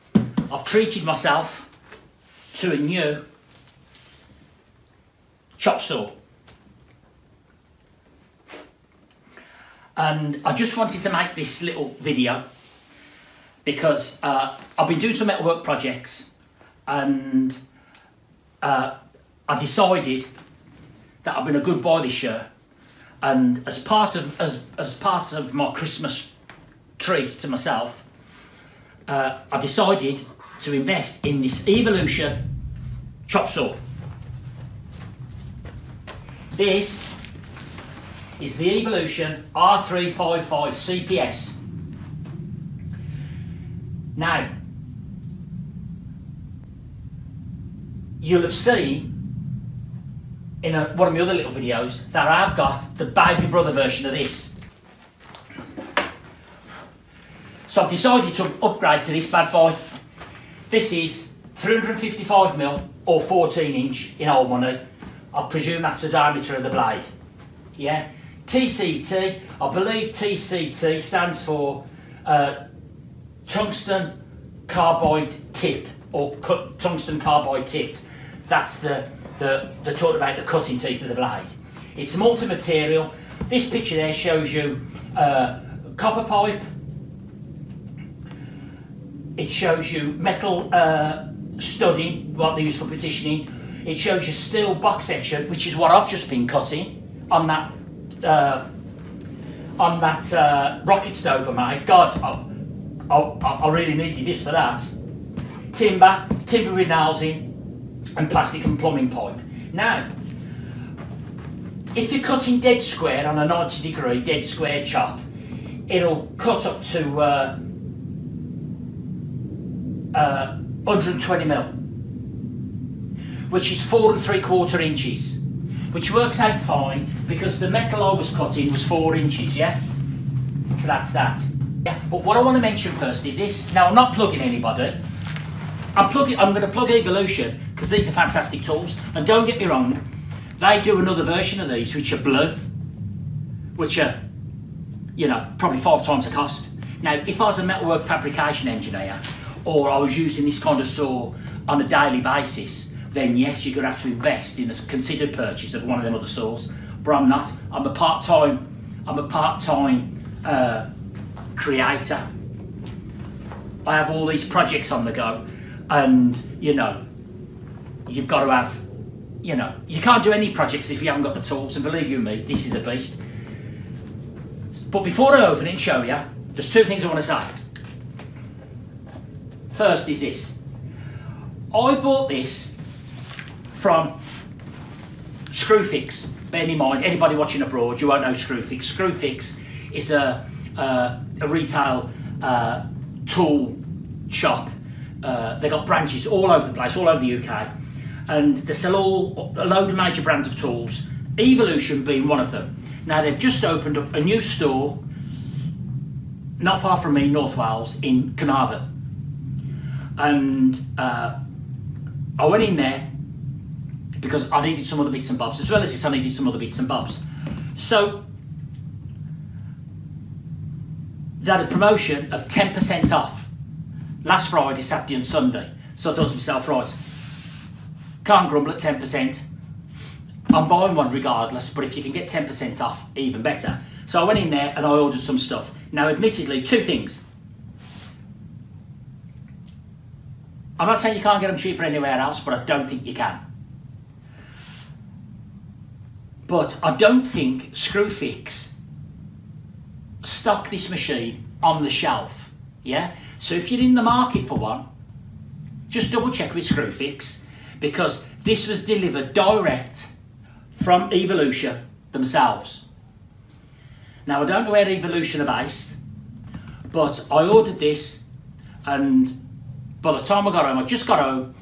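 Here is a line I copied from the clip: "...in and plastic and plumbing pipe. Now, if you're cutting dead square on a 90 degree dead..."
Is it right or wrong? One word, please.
right.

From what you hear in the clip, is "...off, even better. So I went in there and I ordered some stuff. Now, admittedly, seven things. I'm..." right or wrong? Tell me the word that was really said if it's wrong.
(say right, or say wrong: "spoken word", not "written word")
wrong: "two", not "seven".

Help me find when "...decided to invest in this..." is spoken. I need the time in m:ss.
0:29.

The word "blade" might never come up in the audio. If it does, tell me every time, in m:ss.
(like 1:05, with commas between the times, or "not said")
1:06, 1:21.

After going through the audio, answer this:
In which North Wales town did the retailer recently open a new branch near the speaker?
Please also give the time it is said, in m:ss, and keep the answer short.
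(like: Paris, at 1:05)
Carnarvon, at 3:28.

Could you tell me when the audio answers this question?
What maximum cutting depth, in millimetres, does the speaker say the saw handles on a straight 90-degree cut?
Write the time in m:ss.
2:00.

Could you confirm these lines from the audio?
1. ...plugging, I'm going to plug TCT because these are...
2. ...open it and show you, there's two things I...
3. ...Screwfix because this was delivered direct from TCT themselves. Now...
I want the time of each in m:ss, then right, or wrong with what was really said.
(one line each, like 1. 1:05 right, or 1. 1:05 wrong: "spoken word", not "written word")
1. 2:16 wrong: "Evolution", not "TCT"
2. 2:55 right
3. 4:16 wrong: "Evolution", not "TCT".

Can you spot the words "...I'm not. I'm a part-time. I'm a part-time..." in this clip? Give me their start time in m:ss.
2:37.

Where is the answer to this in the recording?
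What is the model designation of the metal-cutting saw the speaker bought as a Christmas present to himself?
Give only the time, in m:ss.
0:39.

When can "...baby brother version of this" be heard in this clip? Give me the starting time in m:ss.
0:53.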